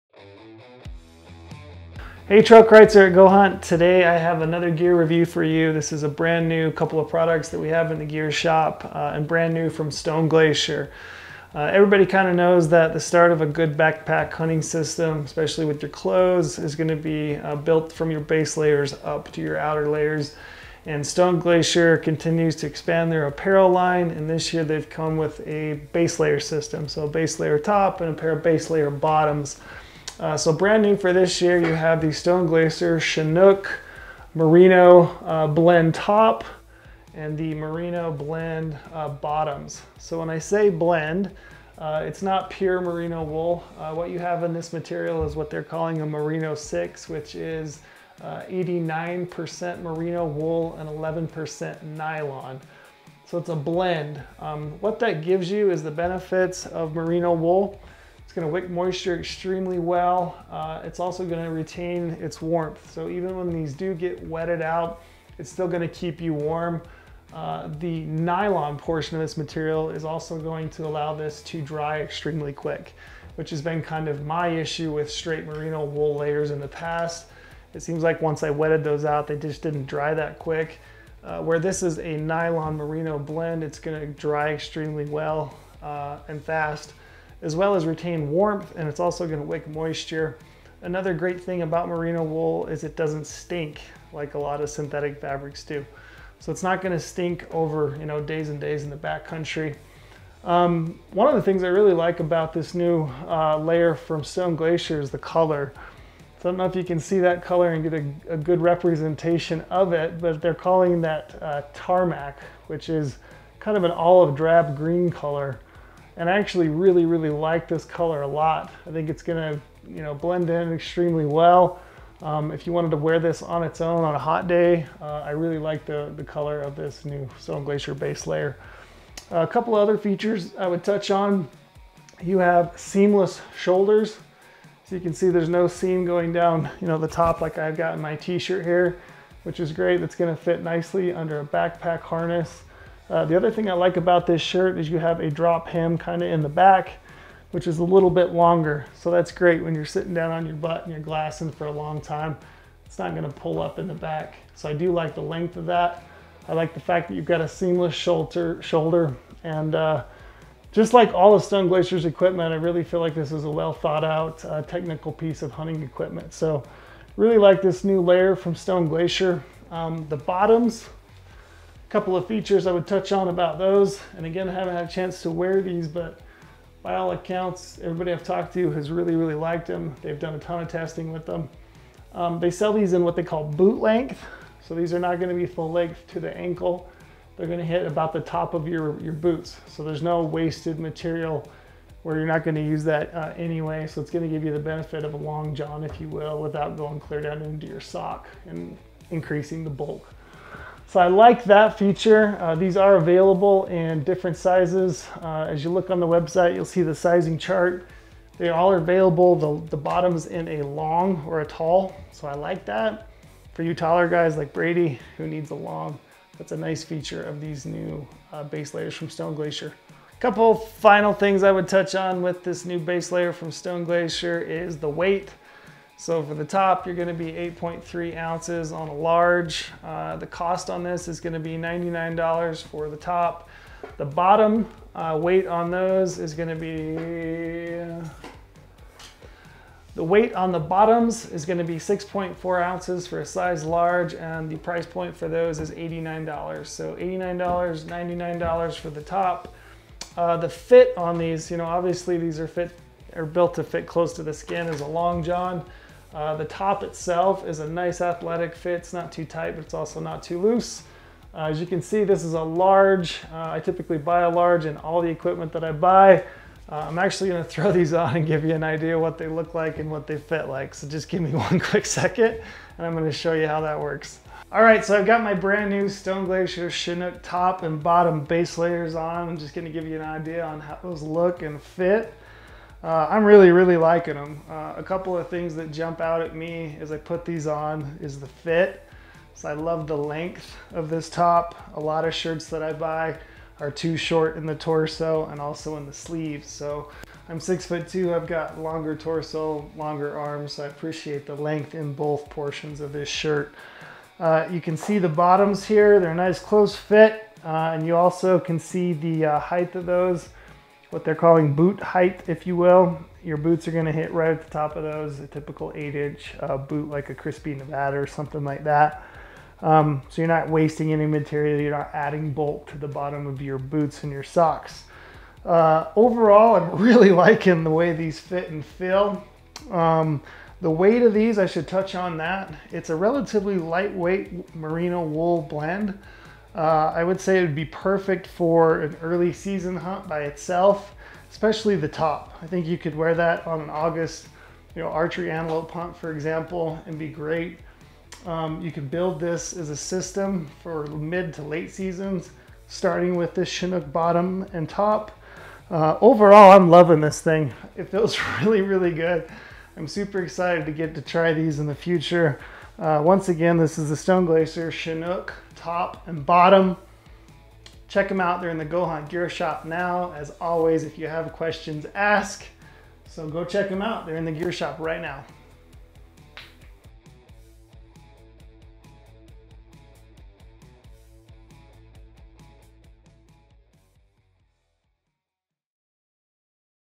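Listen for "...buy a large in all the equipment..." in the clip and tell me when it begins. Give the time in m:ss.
4:23.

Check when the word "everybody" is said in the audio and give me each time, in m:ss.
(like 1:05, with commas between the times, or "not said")
0:11, 2:57.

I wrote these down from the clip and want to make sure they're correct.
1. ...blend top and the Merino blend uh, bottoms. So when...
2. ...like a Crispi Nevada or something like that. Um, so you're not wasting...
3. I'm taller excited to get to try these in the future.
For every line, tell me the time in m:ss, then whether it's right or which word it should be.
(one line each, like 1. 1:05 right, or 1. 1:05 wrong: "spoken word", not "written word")
1. 0:35 right
2. 5:16 right
3. 5:59 wrong: "super", not "taller".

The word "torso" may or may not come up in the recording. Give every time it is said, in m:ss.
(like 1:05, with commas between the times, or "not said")
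4:54, 4:58.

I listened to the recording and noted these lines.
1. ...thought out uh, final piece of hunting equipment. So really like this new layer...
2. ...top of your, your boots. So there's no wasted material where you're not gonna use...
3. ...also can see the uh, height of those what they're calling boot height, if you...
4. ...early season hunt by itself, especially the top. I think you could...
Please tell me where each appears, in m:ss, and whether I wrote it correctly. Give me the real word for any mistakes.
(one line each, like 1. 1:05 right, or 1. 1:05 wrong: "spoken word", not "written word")
1. 2:43 wrong: "technical", not "final"
2. 3:08 right
3. 5:07 right
4. 5:39 right.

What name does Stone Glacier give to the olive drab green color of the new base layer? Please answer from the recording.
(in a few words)
Tarmac.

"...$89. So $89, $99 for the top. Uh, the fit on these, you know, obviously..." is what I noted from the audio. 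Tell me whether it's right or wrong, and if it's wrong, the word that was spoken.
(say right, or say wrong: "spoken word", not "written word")
right.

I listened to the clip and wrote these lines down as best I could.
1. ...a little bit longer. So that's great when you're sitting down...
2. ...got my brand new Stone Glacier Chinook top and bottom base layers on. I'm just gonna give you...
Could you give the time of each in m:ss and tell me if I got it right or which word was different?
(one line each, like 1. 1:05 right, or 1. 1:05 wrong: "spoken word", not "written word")
1. 2:27 right
2. 4:35 right.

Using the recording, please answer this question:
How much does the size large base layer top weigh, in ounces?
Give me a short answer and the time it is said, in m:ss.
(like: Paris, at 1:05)
8.3 ounces, at 3:47.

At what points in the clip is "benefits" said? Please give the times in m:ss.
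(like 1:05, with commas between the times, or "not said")
0:55, 3:14.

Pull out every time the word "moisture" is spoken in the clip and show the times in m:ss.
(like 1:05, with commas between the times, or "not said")
0:58, 1:29.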